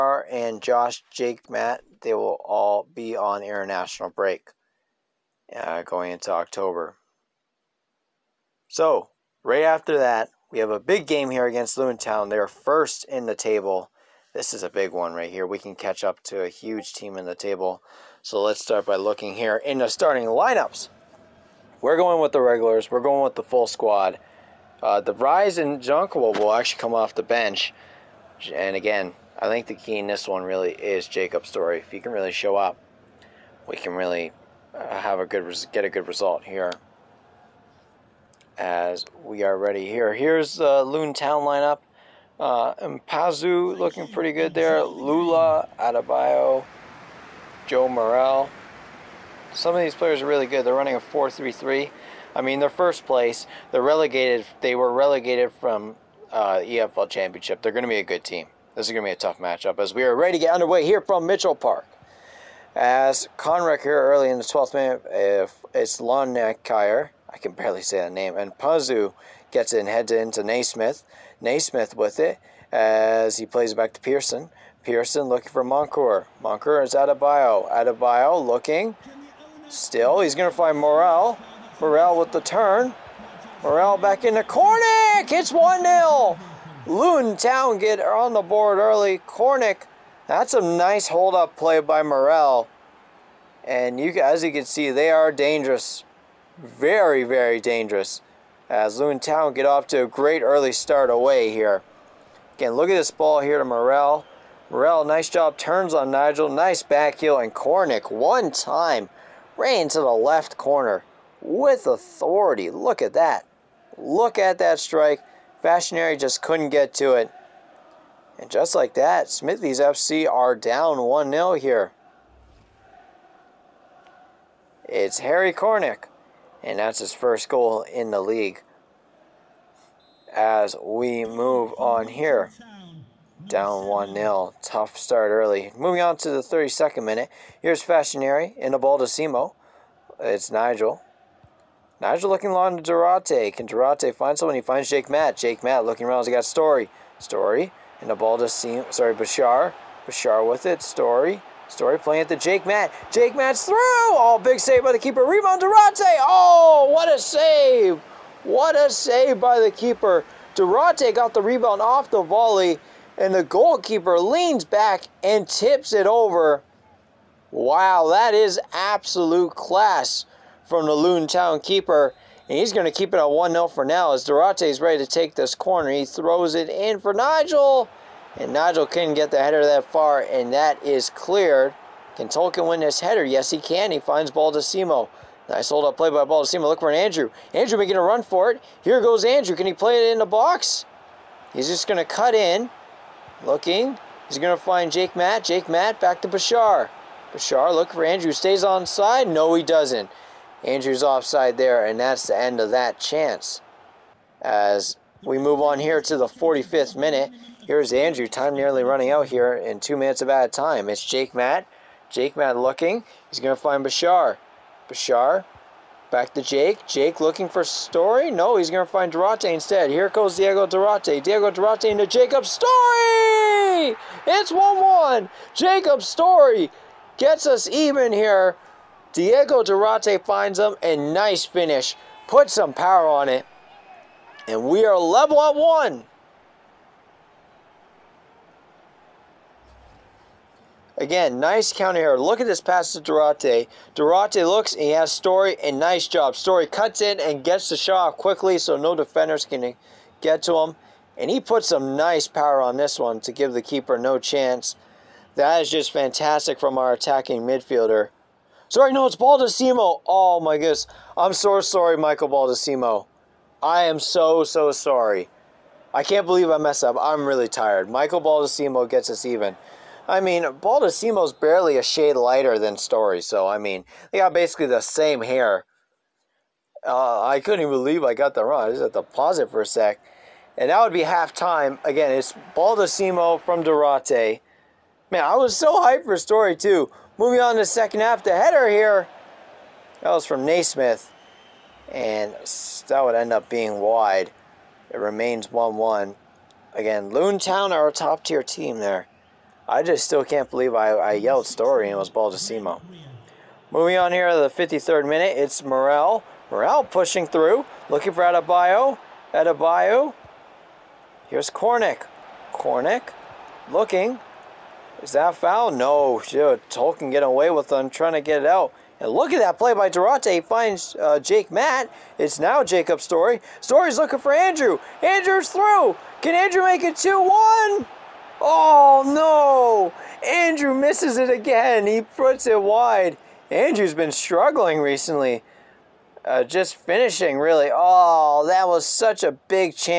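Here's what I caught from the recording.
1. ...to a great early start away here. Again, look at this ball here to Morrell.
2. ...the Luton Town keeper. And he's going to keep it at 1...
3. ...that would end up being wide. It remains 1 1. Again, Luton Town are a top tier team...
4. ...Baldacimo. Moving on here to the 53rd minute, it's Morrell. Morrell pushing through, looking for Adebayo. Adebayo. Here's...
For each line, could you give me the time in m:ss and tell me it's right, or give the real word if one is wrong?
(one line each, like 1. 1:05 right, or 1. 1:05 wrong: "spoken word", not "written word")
1. 1:39 right
2. 2:50 right
3. 4:52 right
4. 5:02 right.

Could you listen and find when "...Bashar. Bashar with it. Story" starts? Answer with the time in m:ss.
2:29.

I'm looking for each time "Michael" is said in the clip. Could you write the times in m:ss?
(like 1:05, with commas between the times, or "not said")
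4:21, 4:27.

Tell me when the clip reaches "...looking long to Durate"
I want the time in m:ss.
2:22.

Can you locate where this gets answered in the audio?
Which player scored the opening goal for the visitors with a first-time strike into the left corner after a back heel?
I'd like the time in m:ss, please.
2:05.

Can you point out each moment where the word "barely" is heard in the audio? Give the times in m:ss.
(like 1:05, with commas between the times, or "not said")
1:07, 4:31.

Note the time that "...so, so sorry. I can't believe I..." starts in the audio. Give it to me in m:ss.
4:23.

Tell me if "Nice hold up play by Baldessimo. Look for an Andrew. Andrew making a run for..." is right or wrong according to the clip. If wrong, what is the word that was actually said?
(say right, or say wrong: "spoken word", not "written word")
right.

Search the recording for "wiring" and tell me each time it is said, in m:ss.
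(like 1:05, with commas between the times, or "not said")
not said.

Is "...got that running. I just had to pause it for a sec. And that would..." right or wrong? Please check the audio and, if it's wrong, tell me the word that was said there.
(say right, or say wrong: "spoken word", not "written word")
wrong: "wrong", not "running".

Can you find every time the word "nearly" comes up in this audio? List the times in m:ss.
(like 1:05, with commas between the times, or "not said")
3:28.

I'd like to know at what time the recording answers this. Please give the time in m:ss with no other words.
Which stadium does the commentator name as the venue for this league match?
1:01.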